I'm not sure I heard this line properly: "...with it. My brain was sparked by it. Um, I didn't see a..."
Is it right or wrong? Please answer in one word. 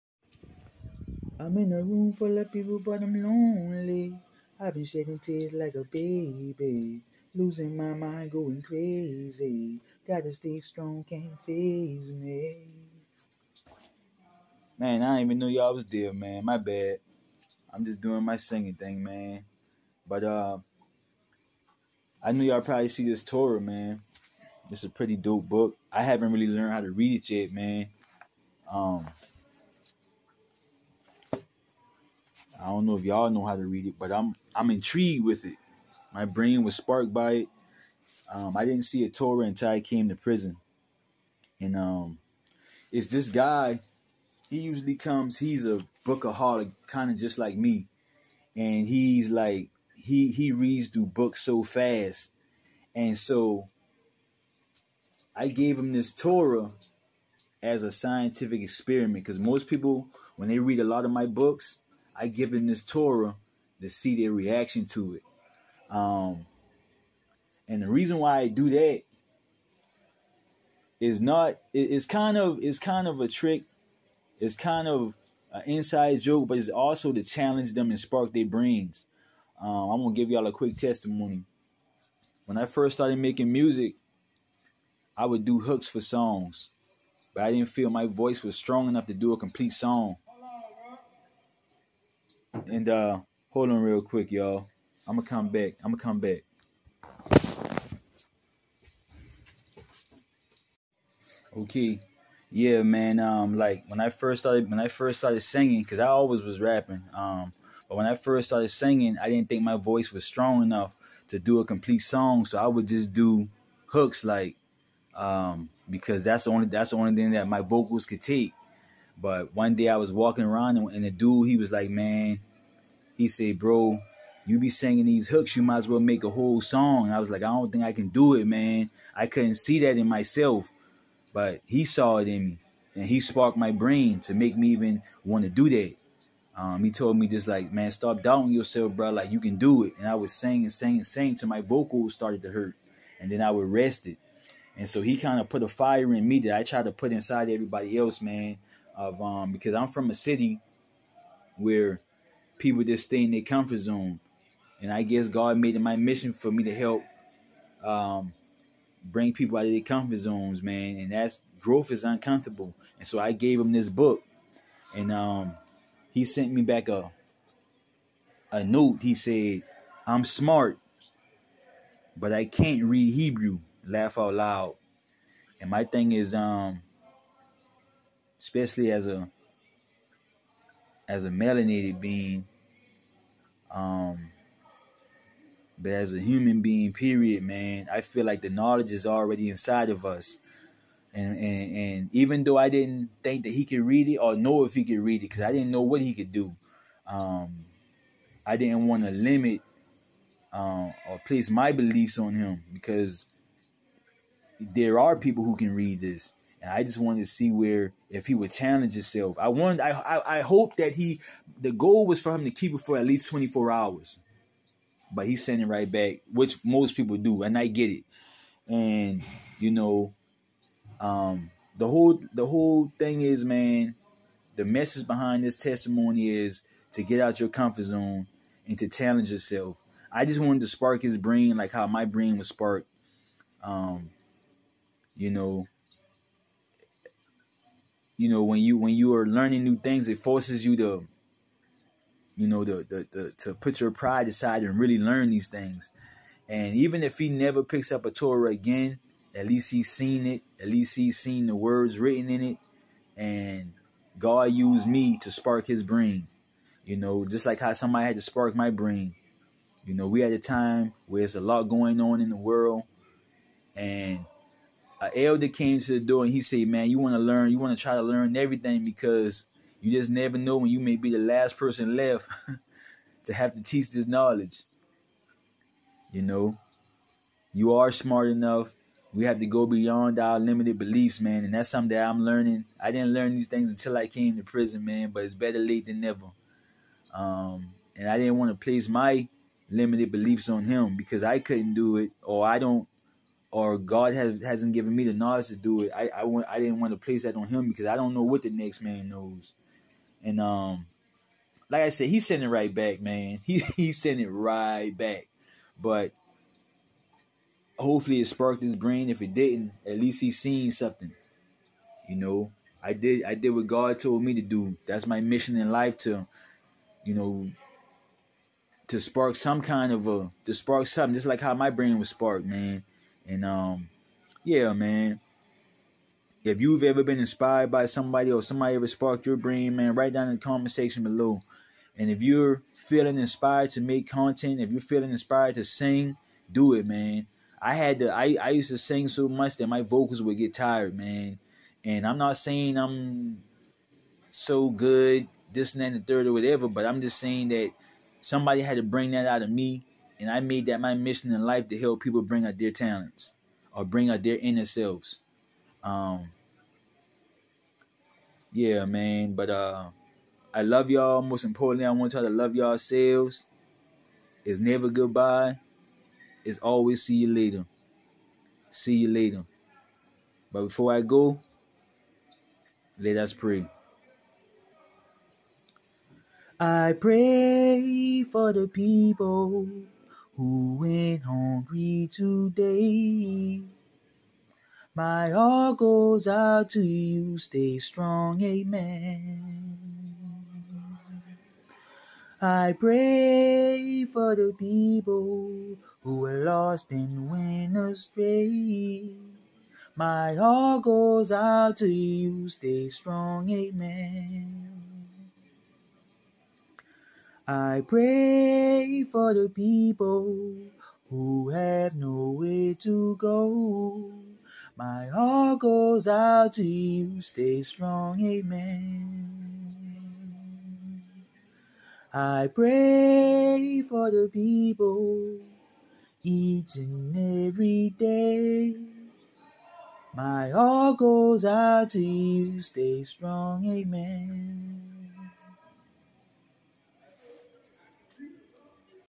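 right.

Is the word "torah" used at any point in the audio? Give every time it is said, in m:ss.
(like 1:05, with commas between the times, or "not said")
0:23, 0:39, 0:56, 1:02, 4:08.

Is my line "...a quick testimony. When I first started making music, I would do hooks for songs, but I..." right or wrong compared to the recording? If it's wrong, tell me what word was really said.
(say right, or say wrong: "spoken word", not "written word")
right.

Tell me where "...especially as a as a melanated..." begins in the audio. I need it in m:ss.
2:58.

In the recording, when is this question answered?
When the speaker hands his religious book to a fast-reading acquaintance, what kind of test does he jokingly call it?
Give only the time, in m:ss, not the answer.
0:57.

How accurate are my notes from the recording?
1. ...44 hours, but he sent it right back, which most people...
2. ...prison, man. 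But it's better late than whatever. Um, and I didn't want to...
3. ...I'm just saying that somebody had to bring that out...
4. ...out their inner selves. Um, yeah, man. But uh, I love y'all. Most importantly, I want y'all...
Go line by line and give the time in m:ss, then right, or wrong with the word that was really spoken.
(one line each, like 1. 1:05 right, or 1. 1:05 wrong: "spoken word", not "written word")
1. 3:33 wrong: "24", not "44"
2. 4:44 wrong: "never", not "whatever"
3. 5:46 right
4. 5:54 right.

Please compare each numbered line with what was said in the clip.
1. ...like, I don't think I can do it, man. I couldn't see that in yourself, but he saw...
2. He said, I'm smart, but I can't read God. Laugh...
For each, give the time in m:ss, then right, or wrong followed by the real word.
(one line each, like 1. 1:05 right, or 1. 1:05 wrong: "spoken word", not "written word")
1. 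2:07 wrong: "myself", not "yourself"
2. 2:49 wrong: "Hebrew", not "God".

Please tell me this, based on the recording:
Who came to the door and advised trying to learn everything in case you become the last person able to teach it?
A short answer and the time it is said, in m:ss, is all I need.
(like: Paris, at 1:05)
an elder, at 4:25.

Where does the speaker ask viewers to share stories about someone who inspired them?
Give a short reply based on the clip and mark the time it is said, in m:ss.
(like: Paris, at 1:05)
comment section, at 5:30.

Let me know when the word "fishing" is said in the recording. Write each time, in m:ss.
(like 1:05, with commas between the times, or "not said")
not said.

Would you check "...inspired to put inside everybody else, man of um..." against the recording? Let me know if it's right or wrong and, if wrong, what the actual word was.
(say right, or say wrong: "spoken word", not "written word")
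wrong: "tried", not "inspired".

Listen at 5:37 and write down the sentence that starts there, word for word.
I had to I, I used to sing so much that my vocals would get tired, man.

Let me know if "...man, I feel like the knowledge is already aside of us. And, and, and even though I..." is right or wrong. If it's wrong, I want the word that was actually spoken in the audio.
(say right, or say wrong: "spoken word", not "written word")
wrong: "inside", not "aside".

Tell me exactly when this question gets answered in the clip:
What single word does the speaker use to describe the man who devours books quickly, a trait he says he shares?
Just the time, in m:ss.
0:46.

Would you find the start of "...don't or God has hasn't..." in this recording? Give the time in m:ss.
4:52.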